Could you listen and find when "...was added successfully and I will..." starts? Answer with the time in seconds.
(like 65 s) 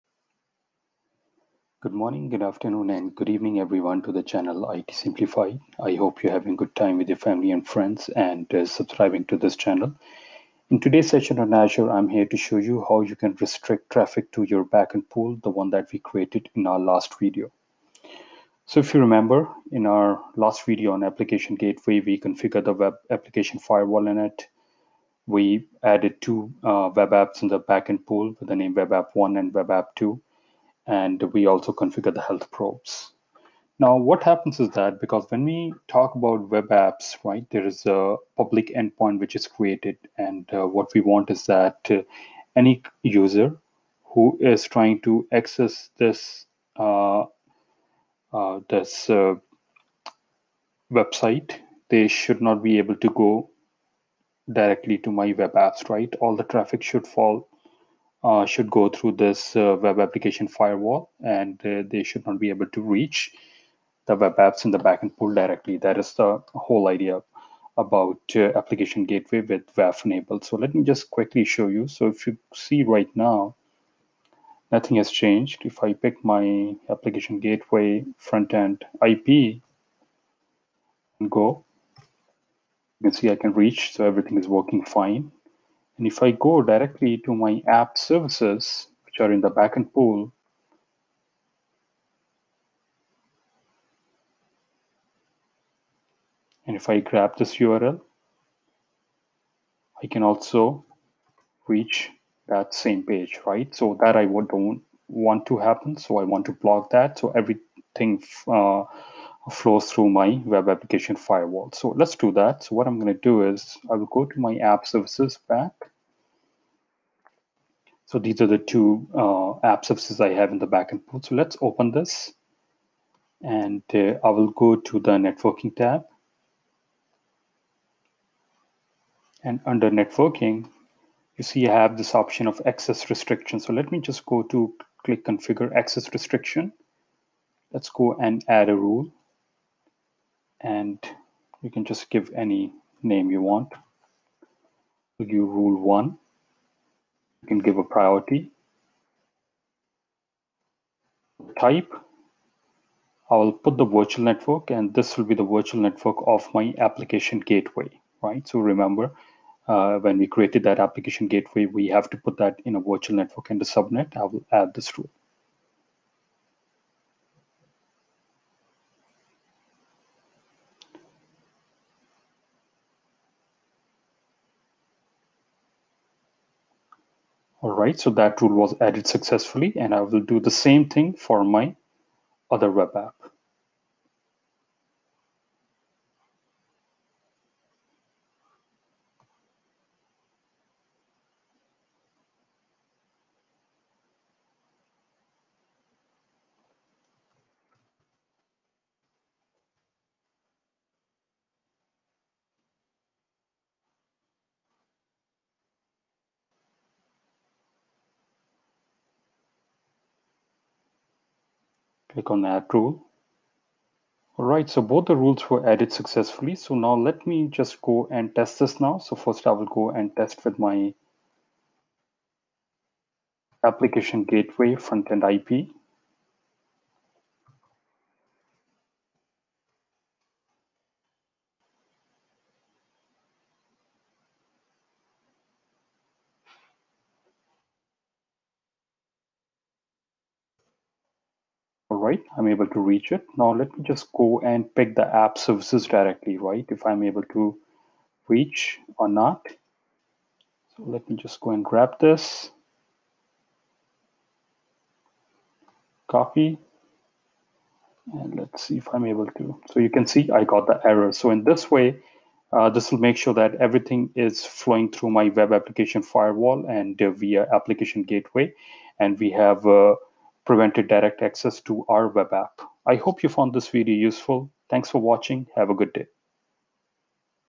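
178 s.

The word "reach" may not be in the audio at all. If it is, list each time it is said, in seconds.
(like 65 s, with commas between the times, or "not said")
62 s, 83 s, 101 s, 242 s, 248 s.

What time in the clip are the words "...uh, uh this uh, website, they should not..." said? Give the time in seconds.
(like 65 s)
46 s.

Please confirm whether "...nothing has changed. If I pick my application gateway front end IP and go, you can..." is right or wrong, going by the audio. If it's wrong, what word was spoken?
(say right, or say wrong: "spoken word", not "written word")
right.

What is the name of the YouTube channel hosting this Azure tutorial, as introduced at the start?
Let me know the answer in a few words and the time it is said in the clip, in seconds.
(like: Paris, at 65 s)
IT Simplified, at 4 s.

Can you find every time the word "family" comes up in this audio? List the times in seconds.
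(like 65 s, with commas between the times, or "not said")
7 s.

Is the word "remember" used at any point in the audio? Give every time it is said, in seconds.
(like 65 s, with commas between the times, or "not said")
18 s, 158 s.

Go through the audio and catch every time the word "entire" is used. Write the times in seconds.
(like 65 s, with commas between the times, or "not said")
not said.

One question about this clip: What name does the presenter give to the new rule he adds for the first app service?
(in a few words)
rule one.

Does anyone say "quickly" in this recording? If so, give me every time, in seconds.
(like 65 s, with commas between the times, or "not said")
71 s.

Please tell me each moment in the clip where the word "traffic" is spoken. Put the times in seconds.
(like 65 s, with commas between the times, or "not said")
13 s, 56 s.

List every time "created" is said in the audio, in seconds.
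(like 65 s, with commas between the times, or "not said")
15 s, 39 s, 160 s.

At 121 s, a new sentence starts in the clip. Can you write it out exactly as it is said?
So let's open this and uh, I will go to the networking tab.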